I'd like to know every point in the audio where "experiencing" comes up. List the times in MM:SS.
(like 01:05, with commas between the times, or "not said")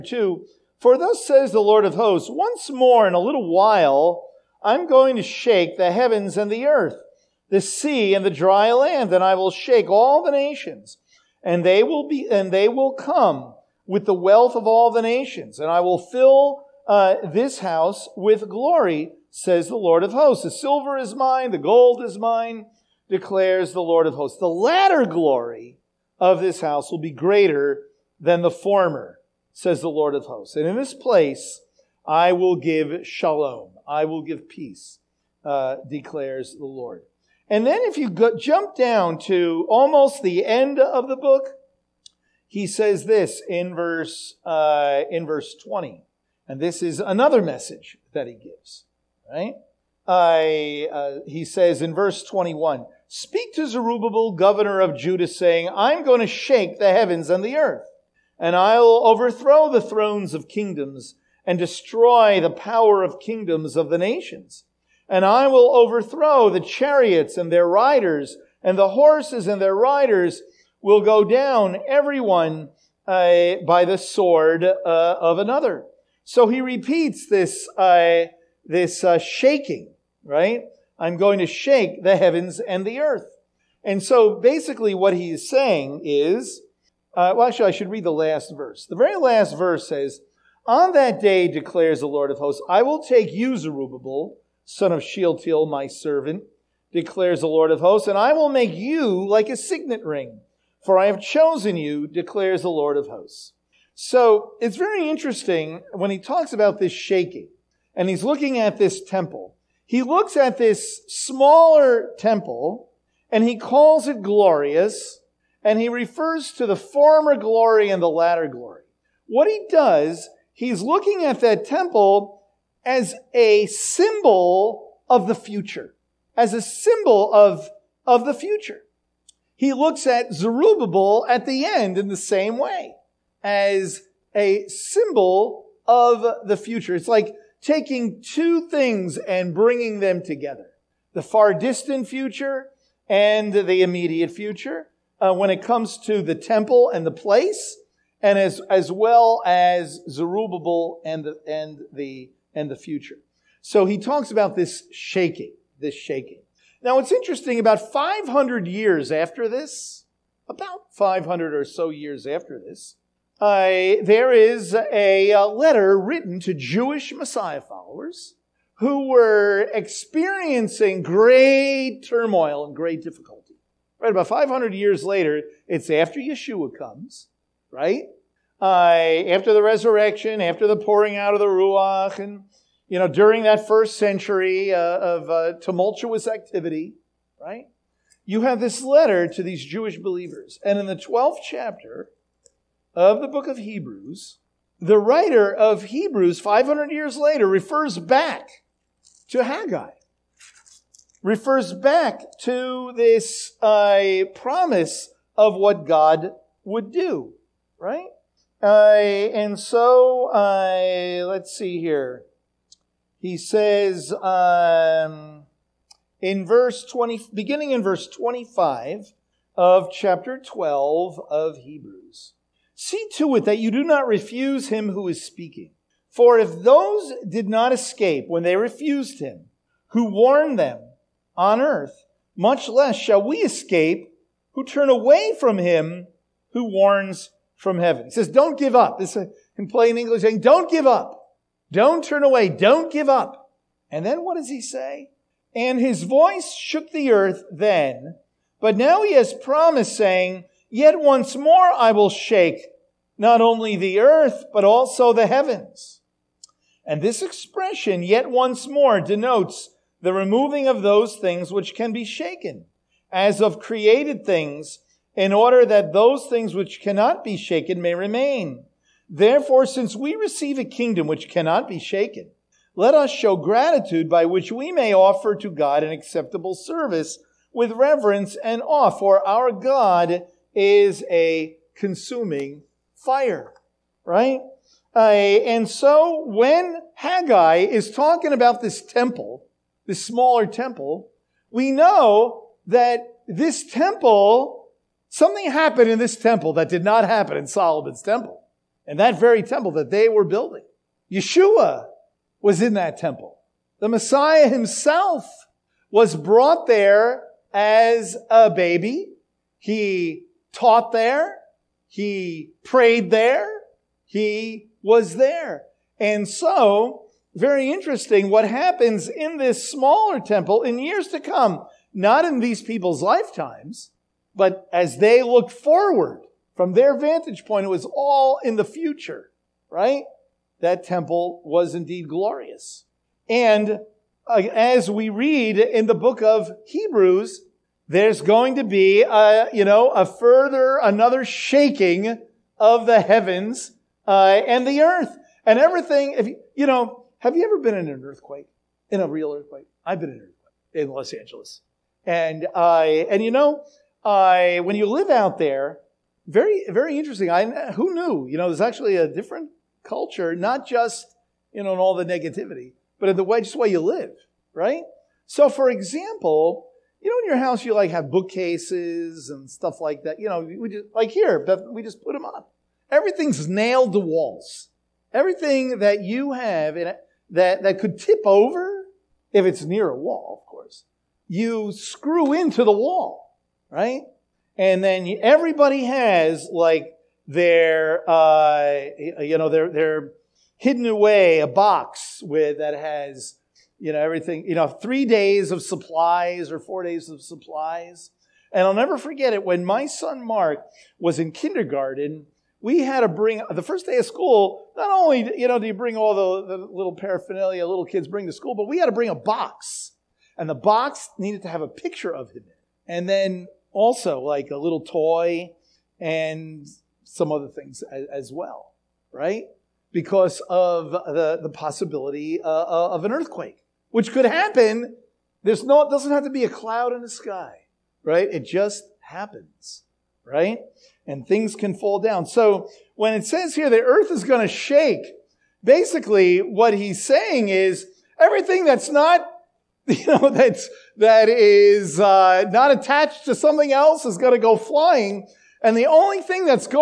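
02:49.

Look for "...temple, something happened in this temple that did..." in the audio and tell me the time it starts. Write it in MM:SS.
04:53.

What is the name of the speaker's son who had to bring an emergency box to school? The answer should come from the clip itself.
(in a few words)
Mark.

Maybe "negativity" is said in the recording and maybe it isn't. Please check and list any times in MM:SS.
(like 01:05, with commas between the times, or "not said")
06:02.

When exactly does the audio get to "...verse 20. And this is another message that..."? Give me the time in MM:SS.
00:45.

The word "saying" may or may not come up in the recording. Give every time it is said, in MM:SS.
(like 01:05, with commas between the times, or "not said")
00:55, 01:25, 04:00, 04:09, 07:17.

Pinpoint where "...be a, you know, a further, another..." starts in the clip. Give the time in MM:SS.
05:38.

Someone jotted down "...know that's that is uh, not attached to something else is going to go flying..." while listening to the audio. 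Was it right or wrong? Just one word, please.
right.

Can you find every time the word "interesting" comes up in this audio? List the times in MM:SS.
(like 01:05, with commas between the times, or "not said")
01:45, 02:37, 05:17, 05:56.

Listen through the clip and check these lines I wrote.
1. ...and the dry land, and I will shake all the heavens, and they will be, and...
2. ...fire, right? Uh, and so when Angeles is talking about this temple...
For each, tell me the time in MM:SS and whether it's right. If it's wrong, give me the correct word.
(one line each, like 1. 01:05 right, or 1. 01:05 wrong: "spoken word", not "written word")
1. 00:08 wrong: "nations", not "heavens"
2. 04:42 wrong: "Haggai", not "Angeles".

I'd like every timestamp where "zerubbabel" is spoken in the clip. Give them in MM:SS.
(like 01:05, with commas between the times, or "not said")
00:53, 01:33, 02:10, 02:30.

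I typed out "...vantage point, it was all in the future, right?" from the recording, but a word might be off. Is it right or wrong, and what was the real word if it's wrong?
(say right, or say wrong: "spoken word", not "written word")
right.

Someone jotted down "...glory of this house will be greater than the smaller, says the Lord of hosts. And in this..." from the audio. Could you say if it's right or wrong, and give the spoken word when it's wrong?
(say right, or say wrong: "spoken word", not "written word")
wrong: "former", not "smaller".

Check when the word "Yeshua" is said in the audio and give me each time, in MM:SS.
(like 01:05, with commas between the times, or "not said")
02:56, 05:01.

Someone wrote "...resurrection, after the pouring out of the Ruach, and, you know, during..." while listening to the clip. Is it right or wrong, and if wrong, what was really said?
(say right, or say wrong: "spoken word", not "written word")
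right.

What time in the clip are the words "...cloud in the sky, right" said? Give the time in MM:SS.
07:06.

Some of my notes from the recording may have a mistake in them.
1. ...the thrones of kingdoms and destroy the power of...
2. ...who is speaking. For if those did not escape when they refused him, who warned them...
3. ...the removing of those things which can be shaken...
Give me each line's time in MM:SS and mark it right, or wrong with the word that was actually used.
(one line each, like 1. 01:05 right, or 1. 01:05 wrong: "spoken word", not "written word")
1. 00:59 right
2. 03:44 right
3. 04:20 right.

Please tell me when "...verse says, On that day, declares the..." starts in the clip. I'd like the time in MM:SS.
01:29.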